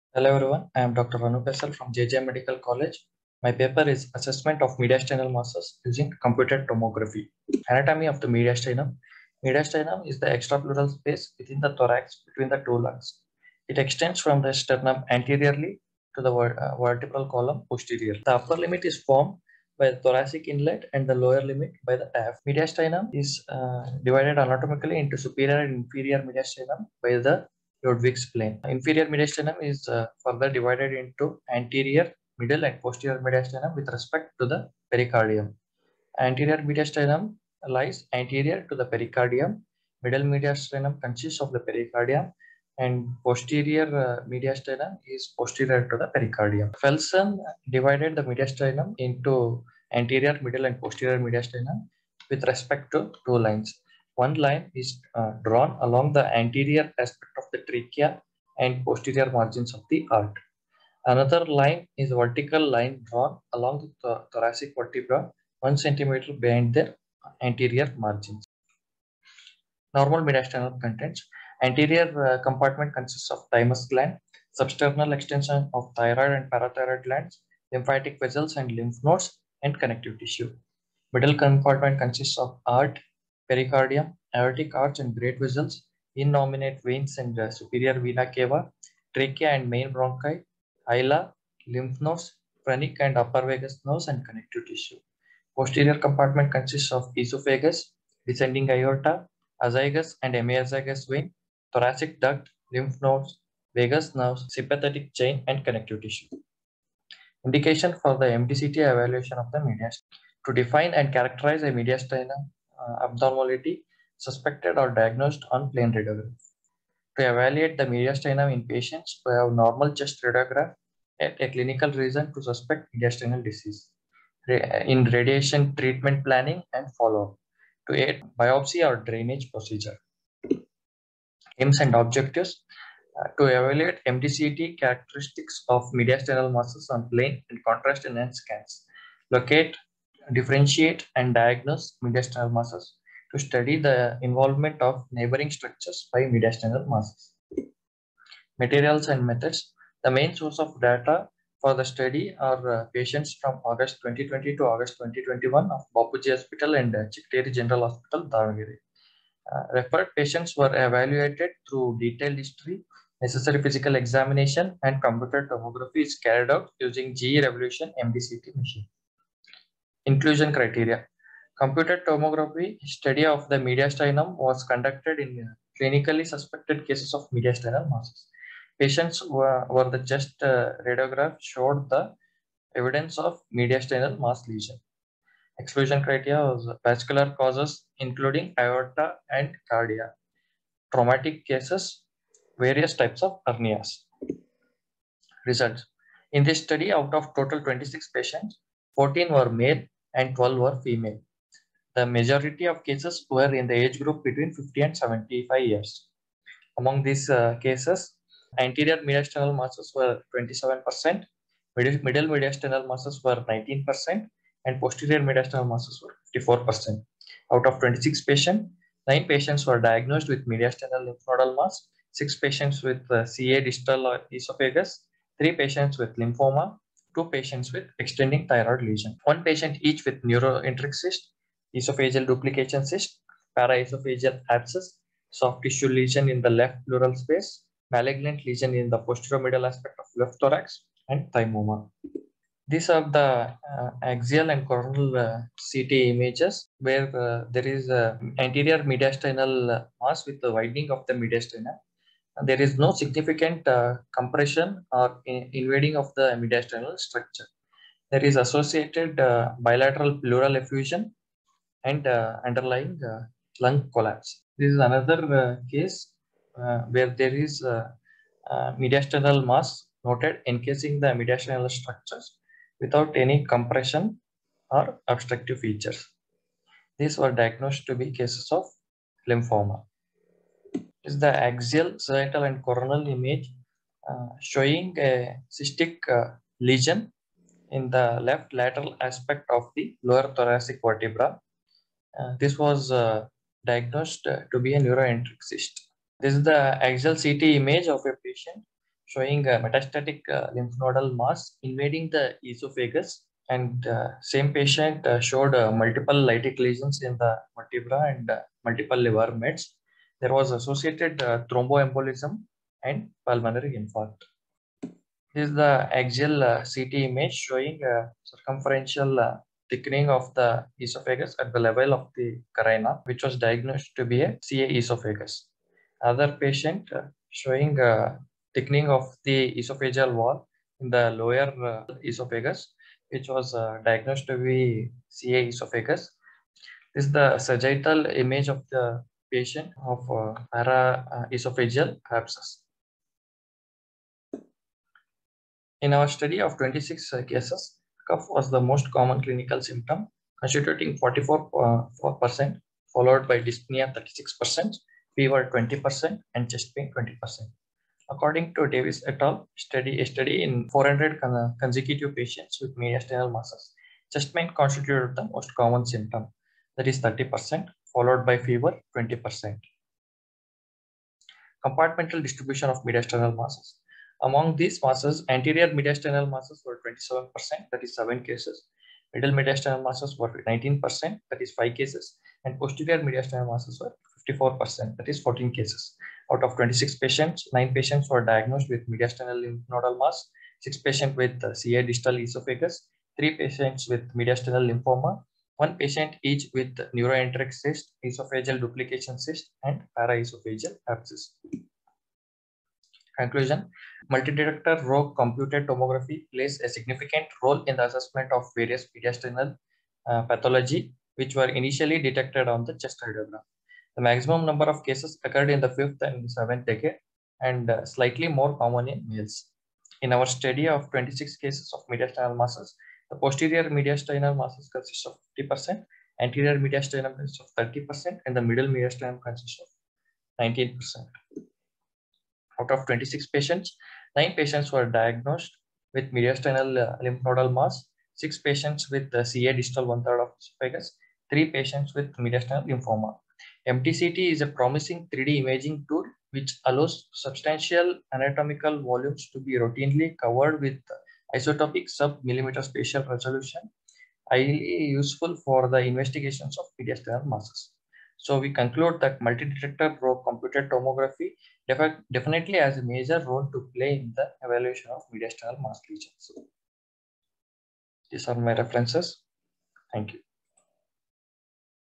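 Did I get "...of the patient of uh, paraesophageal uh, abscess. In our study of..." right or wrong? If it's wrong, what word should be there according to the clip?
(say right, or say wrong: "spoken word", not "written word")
right.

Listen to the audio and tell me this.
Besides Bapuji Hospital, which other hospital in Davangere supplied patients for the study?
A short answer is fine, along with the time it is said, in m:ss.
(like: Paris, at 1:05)
Chigateri General Hospital, at 2:37.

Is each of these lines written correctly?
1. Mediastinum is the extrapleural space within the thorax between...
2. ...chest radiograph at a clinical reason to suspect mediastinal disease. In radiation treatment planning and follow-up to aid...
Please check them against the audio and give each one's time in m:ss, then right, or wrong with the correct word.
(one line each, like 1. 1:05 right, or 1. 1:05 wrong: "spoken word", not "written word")
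1. 0:09 right
2. 1:59 right.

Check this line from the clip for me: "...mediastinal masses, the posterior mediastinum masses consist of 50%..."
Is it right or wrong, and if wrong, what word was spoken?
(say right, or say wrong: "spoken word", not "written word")
right.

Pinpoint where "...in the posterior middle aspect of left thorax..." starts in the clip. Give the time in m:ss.
3:58.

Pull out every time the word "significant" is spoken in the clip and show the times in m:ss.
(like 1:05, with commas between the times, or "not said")
4:12, 6:46.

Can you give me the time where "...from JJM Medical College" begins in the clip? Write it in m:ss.
0:01.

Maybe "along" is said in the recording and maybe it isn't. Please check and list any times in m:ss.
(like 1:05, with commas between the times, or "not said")
0:55, 1:03.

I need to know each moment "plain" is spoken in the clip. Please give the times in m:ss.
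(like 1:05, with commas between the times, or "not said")
1:55, 2:17.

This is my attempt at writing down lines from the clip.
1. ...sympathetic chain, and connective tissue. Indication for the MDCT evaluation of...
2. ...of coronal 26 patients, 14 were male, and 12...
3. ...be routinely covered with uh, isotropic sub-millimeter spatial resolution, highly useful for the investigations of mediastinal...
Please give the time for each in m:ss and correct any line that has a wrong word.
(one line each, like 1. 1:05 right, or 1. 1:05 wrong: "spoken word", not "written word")
1. 1:44 right
2. 3:17 wrong: "total", not "coronal"
3. 7:29 right.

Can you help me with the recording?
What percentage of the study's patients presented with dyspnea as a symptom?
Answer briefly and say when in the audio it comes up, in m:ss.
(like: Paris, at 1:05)
36%, at 5:53.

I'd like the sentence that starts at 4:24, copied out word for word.
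This is another uh, case uh, where there is mediastinal mass noted encasing the mediastinal structures without any compression or obstructive features.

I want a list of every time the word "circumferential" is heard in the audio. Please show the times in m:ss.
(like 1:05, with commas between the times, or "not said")
5:18.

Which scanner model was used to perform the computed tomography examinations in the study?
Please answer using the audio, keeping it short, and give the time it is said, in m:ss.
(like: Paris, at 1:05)
GE Revolution, at 2:47.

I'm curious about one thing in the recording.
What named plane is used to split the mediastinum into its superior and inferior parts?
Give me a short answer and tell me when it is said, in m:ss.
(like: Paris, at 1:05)
Ludwig's plane, at 0:27.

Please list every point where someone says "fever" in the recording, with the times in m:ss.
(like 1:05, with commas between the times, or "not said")
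5:55, 6:08.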